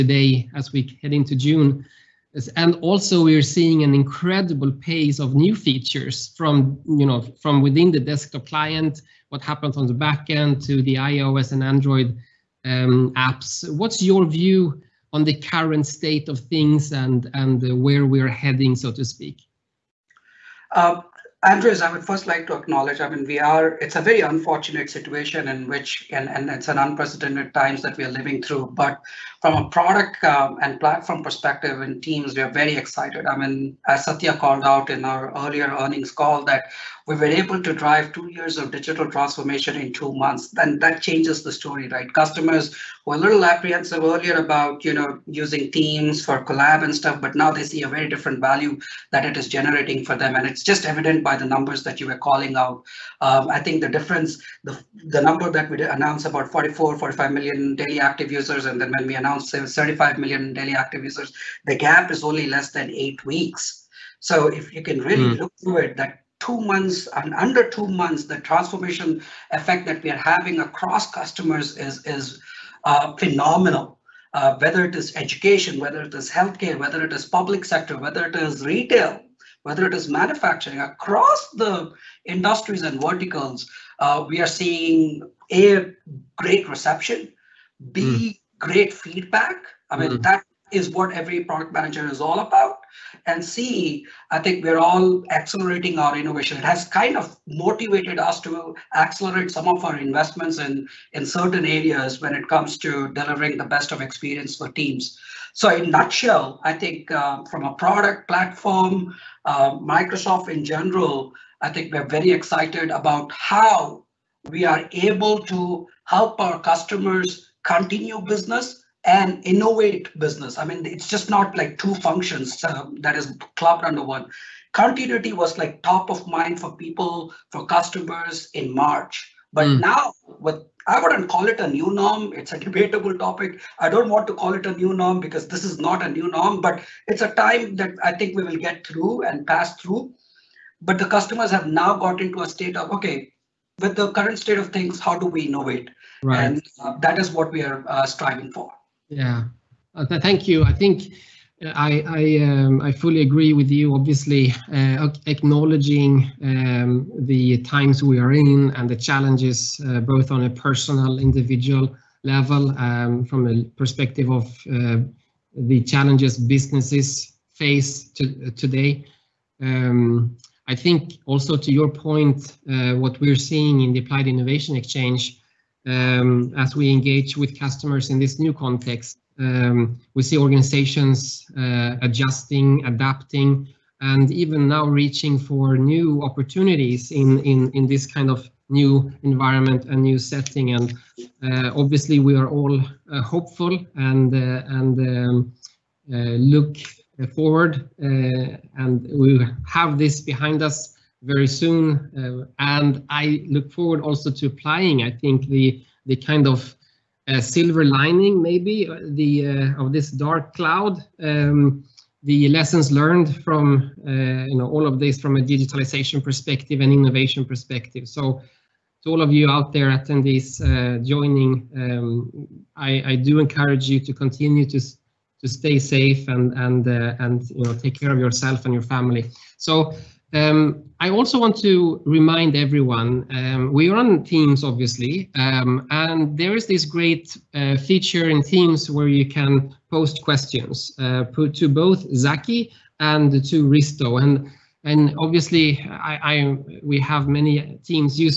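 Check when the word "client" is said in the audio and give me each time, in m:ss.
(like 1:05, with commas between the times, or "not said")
0:08.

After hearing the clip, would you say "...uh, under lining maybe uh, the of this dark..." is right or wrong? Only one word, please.
wrong.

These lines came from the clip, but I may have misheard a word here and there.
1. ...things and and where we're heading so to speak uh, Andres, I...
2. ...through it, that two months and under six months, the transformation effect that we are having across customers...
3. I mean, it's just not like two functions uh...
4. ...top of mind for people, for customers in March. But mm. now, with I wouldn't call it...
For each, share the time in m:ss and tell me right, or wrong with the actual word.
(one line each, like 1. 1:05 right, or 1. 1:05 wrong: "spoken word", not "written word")
1. 0:16 right
2. 1:05 wrong: "two", not "six"
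3. 2:00 right
4. 2:05 right.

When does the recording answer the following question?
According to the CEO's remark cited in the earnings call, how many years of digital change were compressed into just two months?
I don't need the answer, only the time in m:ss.
0:38.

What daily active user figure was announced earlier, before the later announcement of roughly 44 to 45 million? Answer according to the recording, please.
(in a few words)
35 million.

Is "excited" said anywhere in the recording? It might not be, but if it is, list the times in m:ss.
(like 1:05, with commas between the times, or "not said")
0:32, 1:52.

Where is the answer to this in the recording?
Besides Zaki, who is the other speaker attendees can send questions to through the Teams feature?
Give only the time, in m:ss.
4:03.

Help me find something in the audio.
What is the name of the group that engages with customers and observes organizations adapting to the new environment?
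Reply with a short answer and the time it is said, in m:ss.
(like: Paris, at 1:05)
Applied Innovation Exchange, at 2:53.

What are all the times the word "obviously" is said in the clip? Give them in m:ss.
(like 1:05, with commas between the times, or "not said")
2:33, 3:11, 3:54, 4:05.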